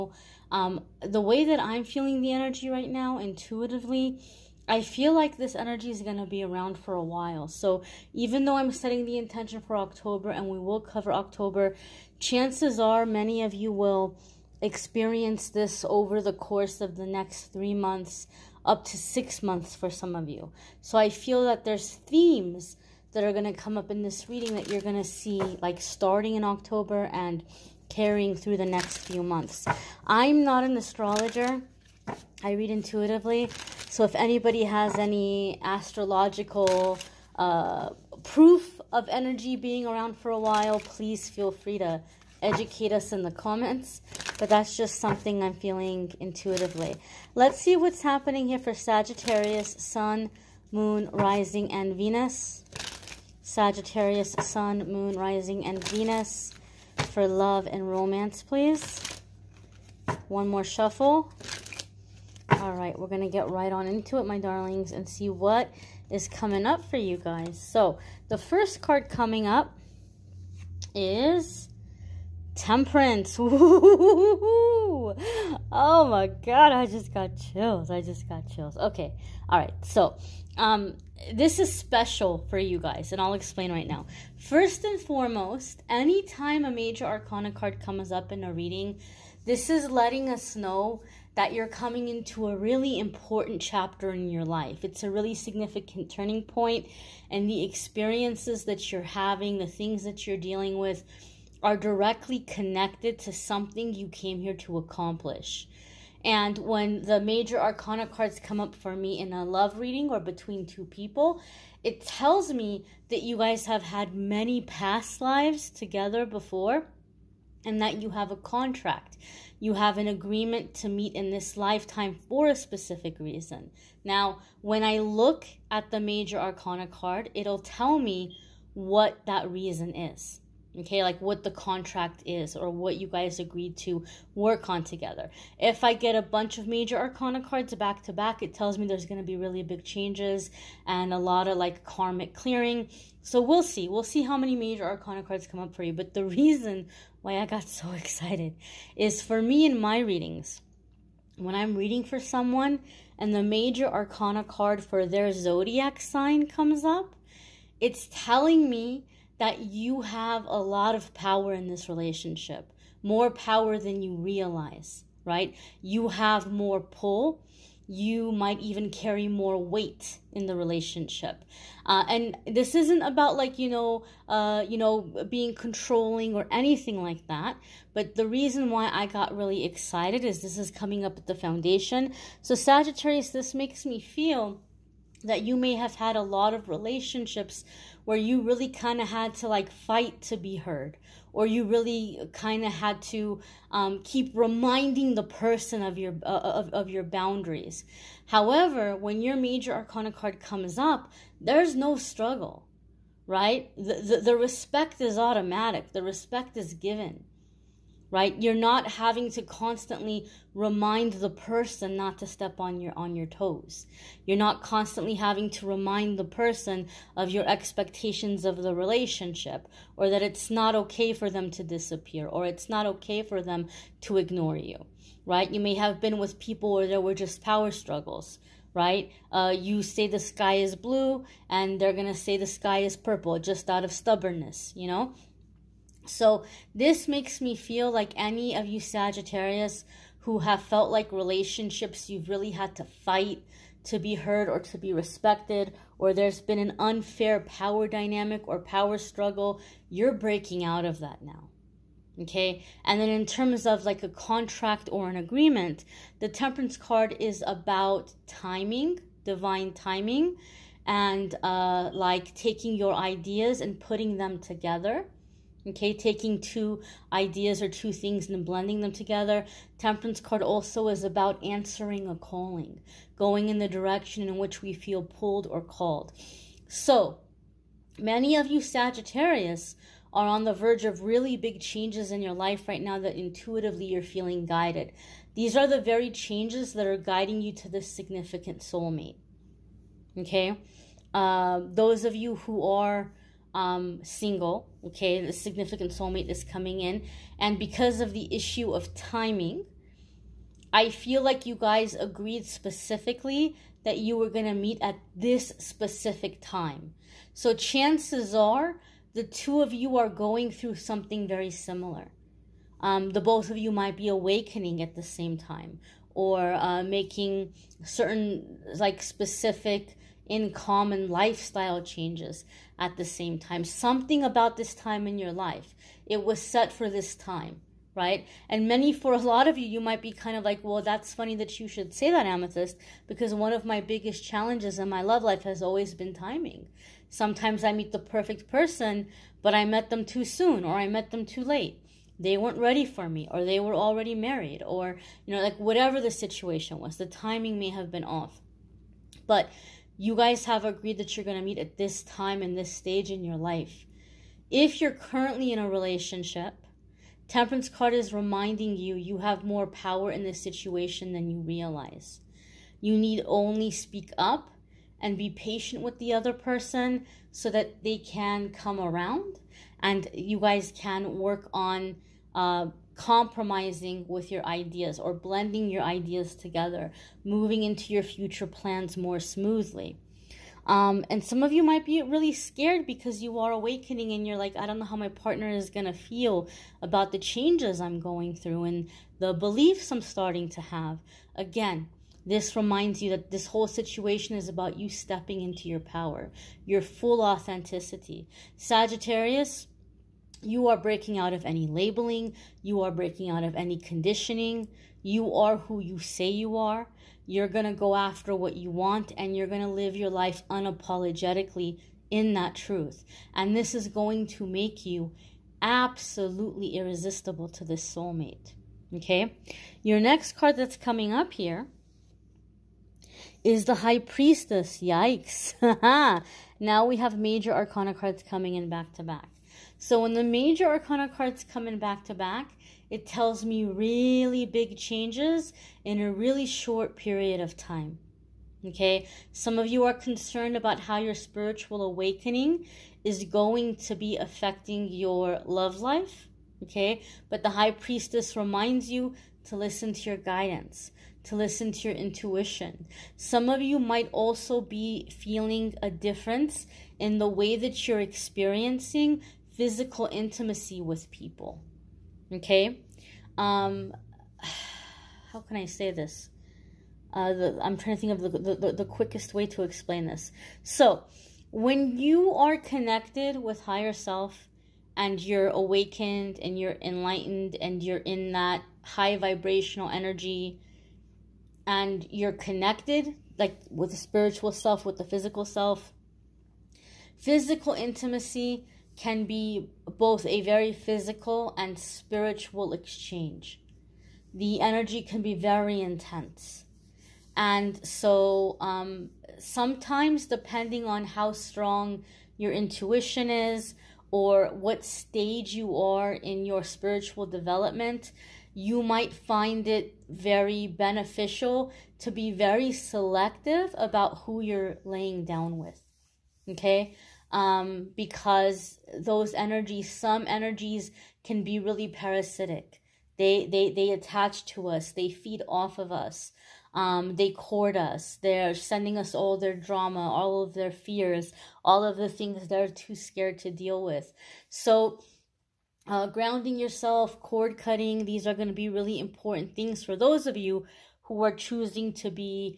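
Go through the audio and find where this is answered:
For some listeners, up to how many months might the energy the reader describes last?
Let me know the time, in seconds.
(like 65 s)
18 s.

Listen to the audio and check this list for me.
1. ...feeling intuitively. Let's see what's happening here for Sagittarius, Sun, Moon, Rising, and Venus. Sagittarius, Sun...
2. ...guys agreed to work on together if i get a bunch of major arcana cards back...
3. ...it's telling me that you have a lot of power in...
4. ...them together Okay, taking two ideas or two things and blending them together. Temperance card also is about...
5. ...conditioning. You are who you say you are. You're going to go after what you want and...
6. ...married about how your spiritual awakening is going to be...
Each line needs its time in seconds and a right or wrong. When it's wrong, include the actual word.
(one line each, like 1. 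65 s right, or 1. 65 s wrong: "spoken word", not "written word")
1. 45 s right
2. 133 s right
3. 157 s right
4. 264 s right
5. 403 s right
6. 439 s wrong: "concerned", not "married".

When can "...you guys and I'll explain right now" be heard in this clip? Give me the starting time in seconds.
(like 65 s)
82 s.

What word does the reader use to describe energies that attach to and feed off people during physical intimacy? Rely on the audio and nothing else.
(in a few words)
Parasitic.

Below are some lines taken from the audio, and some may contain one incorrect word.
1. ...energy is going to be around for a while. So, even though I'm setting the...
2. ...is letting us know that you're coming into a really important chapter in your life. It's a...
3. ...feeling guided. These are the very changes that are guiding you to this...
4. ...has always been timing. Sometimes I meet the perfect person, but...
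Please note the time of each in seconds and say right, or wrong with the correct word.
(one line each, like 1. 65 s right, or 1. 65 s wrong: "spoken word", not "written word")
1. 5 s right
2. 89 s right
3. 284 s right
4. 335 s right.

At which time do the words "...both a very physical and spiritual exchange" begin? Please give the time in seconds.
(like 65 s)
489 s.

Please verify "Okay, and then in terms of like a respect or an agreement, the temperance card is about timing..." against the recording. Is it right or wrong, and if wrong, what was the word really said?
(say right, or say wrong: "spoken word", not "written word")
wrong: "contract", not "respect".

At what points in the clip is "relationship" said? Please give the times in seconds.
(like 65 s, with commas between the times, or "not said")
161 s, 170 s, 186 s, 218 s, 241 s, 355 s.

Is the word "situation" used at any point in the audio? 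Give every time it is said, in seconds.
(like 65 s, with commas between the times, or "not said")
346 s, 360 s, 393 s.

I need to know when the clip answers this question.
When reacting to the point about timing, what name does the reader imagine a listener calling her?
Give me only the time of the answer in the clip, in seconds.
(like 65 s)
332 s.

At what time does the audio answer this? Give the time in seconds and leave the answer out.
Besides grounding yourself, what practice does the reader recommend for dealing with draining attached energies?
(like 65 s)
537 s.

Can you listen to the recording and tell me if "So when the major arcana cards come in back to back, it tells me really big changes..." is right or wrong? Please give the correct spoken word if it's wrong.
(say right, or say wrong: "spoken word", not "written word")
right.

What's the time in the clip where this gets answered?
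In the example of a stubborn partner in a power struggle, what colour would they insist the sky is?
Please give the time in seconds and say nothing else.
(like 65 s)
232 s.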